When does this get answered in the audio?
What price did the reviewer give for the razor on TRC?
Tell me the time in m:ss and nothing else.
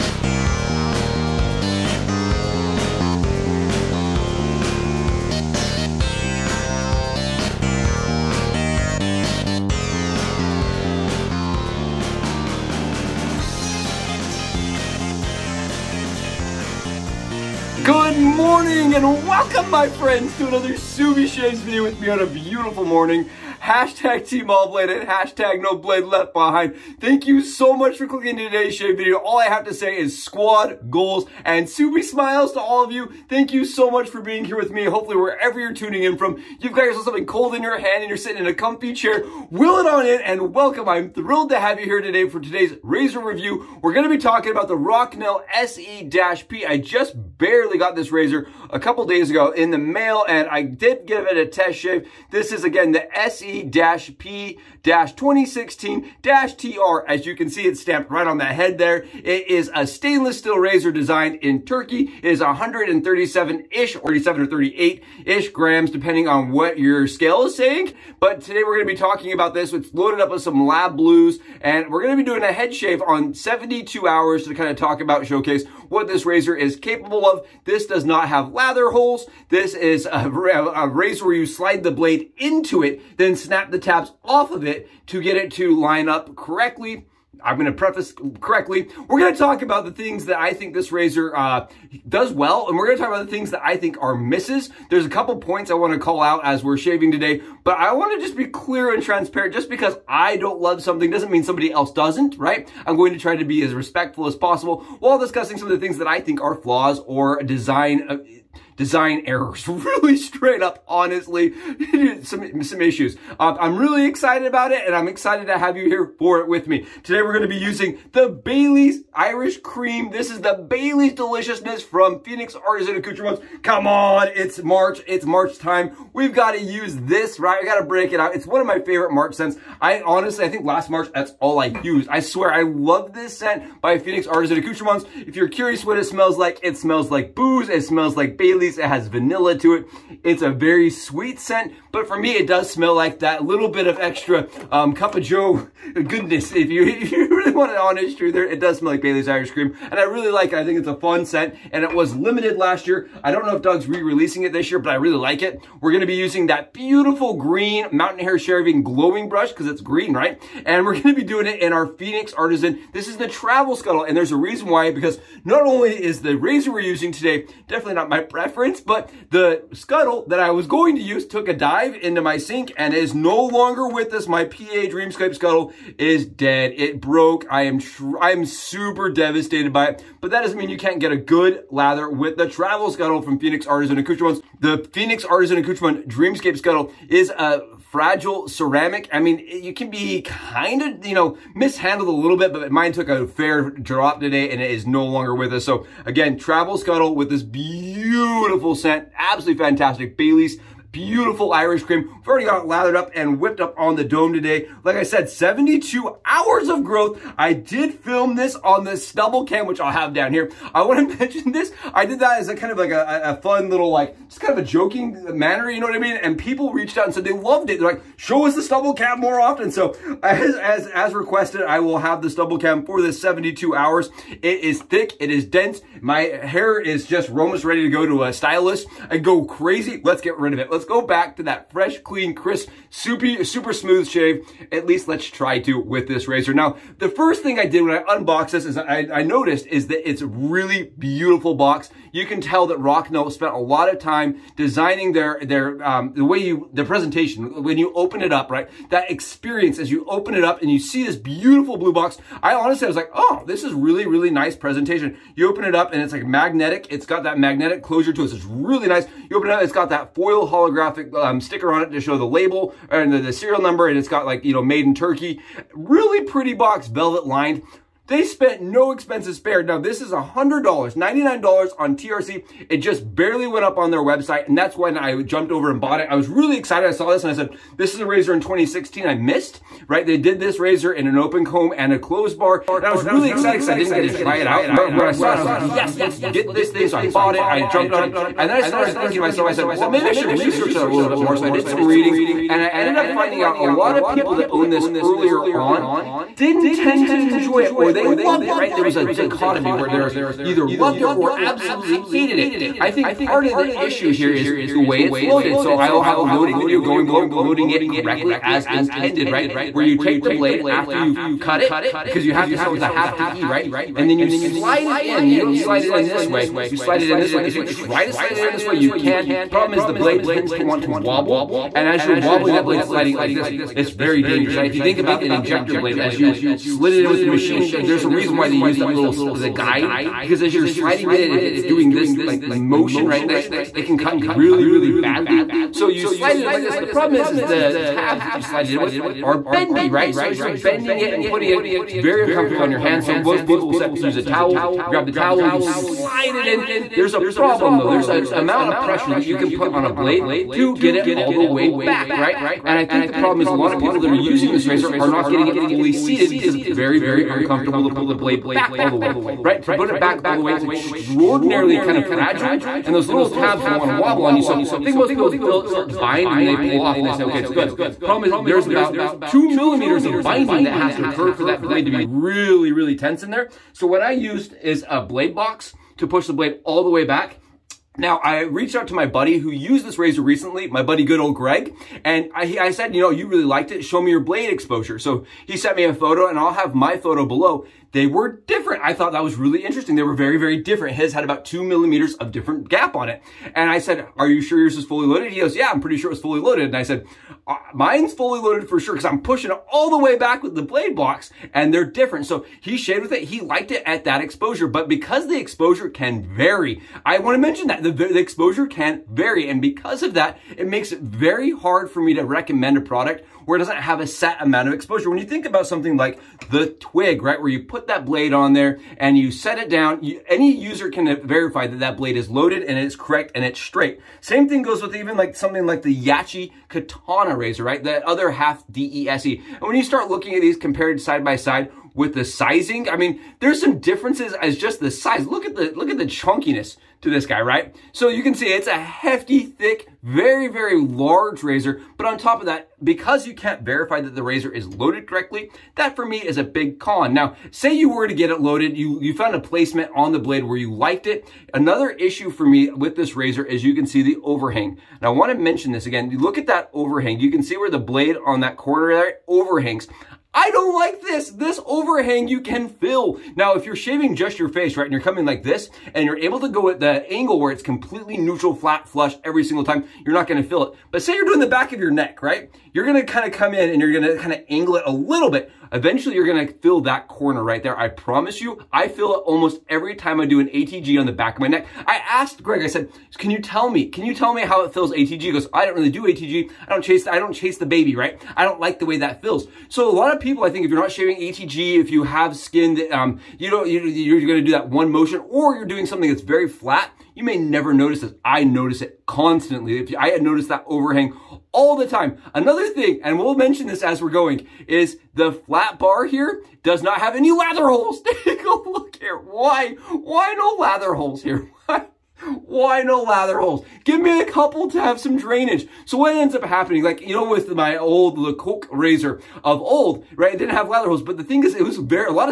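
4:30.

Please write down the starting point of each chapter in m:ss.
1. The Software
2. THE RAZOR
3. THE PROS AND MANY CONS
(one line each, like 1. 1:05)
1. 1:56
2. 0:43
3. 3:56.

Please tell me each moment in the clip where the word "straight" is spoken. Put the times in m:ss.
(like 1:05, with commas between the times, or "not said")
1:50, 7:03.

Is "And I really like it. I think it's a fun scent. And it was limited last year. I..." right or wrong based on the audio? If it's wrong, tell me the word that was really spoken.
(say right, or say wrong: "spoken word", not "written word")
right.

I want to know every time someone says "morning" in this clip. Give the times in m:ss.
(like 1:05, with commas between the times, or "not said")
0:22.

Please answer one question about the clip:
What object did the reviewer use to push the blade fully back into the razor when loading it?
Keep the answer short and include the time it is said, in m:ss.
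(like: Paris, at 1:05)
A blade box, at 6:14.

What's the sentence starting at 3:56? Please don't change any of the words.
Now, the first thing I did when I unboxed this is I, I noticed is that it's a really beautiful box.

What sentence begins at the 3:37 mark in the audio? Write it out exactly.
They're like, show us the stubble cam more often.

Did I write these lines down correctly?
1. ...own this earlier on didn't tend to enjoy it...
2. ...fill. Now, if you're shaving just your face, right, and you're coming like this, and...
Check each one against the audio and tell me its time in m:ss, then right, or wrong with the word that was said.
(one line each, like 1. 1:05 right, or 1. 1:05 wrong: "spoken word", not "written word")
1. 4:54 right
2. 7:42 right.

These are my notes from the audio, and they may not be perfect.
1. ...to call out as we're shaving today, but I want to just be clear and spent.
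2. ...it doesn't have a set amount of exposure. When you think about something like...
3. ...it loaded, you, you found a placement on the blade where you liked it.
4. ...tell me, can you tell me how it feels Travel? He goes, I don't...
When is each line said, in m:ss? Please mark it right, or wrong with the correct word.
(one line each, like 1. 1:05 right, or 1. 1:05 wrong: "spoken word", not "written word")
1. 1:35 wrong: "transparent", not "spent"
2. 6:53 right
3. 7:28 right
4. 8:03 wrong: "ATG", not "Travel".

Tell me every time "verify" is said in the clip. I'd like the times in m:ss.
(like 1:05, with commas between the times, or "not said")
7:01, 7:23.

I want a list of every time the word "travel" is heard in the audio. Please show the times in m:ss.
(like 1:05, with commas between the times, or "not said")
2:43, 3:02, 3:16.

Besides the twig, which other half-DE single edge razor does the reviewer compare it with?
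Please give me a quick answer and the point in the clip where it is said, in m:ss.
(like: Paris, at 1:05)
Yaqi Katana, at 7:05.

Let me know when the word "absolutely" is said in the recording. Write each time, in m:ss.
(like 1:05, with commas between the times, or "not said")
3:19, 5:01.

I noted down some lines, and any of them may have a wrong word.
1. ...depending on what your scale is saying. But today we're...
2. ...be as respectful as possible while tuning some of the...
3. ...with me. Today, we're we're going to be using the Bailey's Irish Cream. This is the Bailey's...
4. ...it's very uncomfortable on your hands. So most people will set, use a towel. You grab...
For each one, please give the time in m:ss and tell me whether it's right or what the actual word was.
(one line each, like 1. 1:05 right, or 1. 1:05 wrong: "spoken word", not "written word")
1. 1:05 right
2. 1:43 wrong: "discussing", not "tuning"
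3. 1:56 right
4. 5:41 right.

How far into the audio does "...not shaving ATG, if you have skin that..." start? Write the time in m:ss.
8:10.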